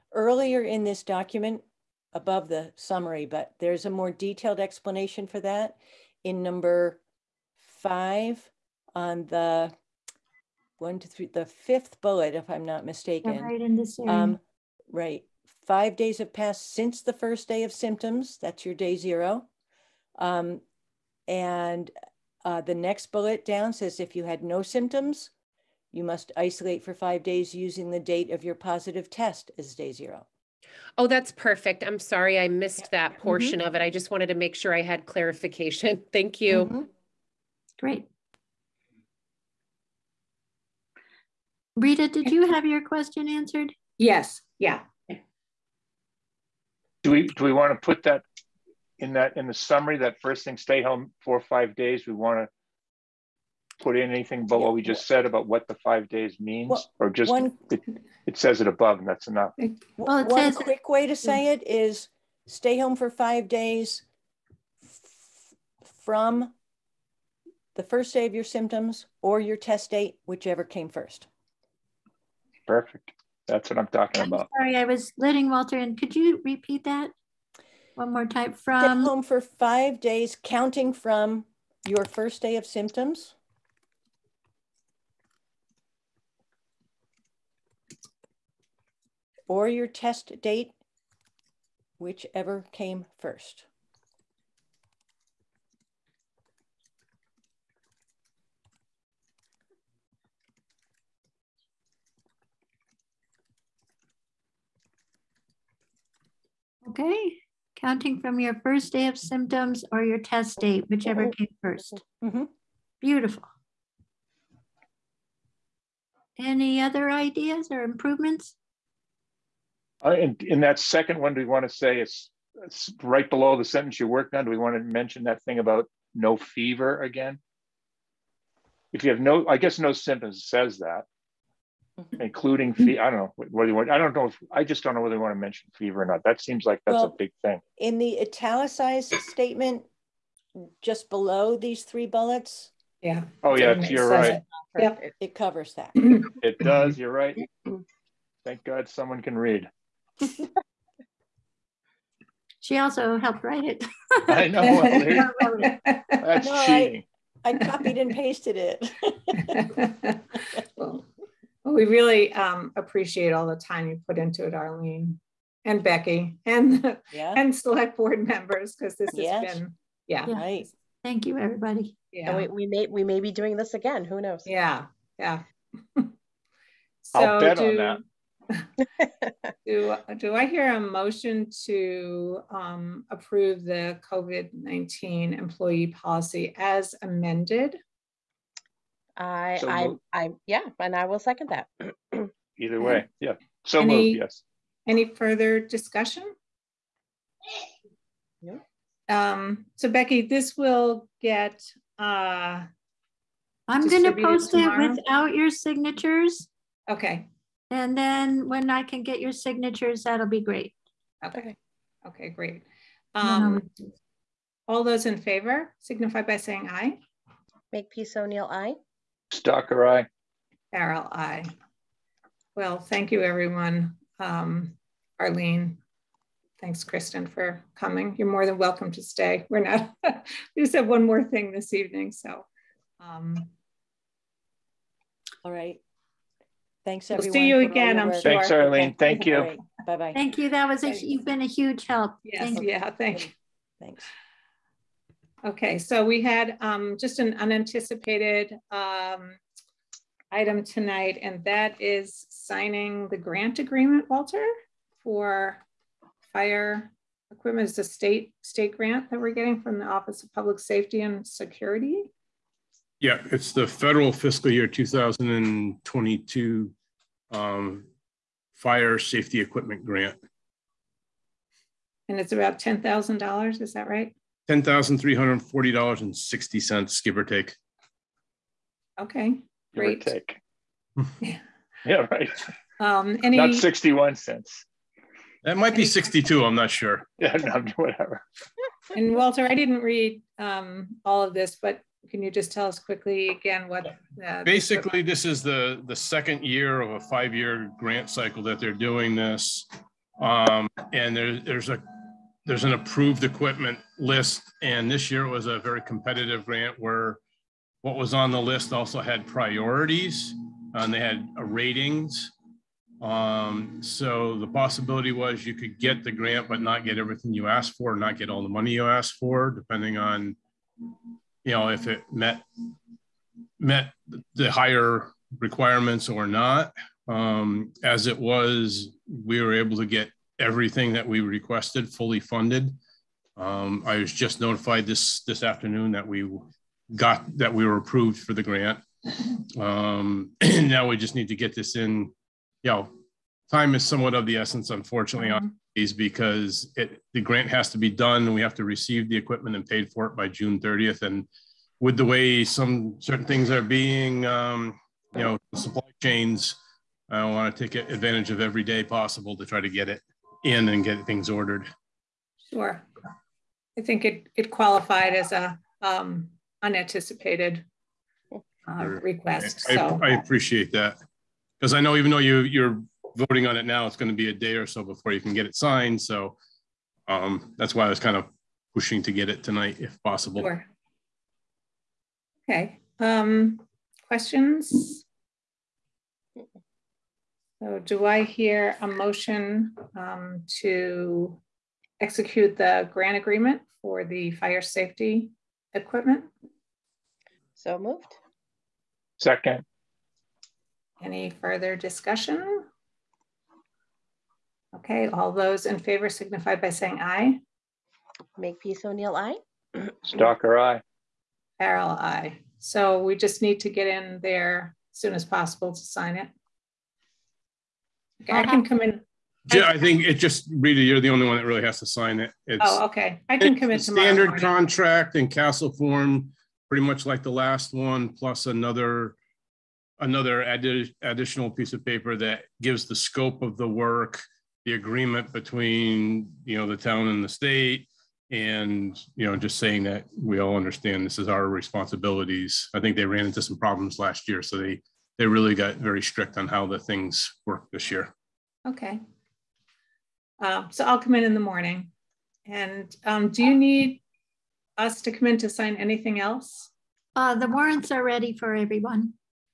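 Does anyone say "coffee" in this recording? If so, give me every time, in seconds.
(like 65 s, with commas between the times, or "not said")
not said.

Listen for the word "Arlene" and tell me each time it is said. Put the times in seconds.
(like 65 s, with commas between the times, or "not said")
164 s, 225 s, 238 s.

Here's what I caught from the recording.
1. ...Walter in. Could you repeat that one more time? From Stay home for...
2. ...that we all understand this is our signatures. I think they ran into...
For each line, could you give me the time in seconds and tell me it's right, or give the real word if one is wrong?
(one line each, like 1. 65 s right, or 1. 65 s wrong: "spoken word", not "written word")
1. 75 s right
2. 439 s wrong: "responsibilities", not "signatures".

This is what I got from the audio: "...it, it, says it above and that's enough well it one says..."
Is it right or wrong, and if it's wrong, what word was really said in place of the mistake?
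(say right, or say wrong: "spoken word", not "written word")
right.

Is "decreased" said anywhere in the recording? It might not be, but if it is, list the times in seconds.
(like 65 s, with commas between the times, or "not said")
not said.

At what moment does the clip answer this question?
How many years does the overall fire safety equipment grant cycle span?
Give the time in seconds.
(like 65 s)
296 s.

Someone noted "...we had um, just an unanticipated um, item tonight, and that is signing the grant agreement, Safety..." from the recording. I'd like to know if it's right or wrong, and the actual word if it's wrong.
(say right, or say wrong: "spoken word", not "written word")
wrong: "Walter", not "Safety".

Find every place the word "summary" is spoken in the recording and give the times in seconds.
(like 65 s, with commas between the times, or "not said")
2 s, 49 s.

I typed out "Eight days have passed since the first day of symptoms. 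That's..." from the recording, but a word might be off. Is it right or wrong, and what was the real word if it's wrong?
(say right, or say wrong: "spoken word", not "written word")
wrong: "Five", not "Eight".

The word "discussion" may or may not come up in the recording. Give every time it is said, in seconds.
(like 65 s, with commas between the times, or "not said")
195 s, 401 s.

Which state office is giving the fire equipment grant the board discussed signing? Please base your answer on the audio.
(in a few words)
Office of Public Safety and Security.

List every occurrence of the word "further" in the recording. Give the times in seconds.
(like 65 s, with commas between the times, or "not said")
195 s, 401 s.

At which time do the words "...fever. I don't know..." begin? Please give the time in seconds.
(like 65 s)
132 s.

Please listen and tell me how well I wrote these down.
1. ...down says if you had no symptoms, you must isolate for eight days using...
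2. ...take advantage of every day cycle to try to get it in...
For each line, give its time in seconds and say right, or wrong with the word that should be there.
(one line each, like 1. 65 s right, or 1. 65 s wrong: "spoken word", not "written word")
1. 23 s wrong: "five", not "eight"
2. 357 s wrong: "possible", not "cycle".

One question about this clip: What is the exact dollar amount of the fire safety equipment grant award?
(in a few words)
$10,340.60.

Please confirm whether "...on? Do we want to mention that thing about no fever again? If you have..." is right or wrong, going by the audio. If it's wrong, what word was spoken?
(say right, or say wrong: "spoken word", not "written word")
right.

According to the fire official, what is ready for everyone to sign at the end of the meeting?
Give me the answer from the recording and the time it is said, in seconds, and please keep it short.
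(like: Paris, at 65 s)
the warrants, at 457 s.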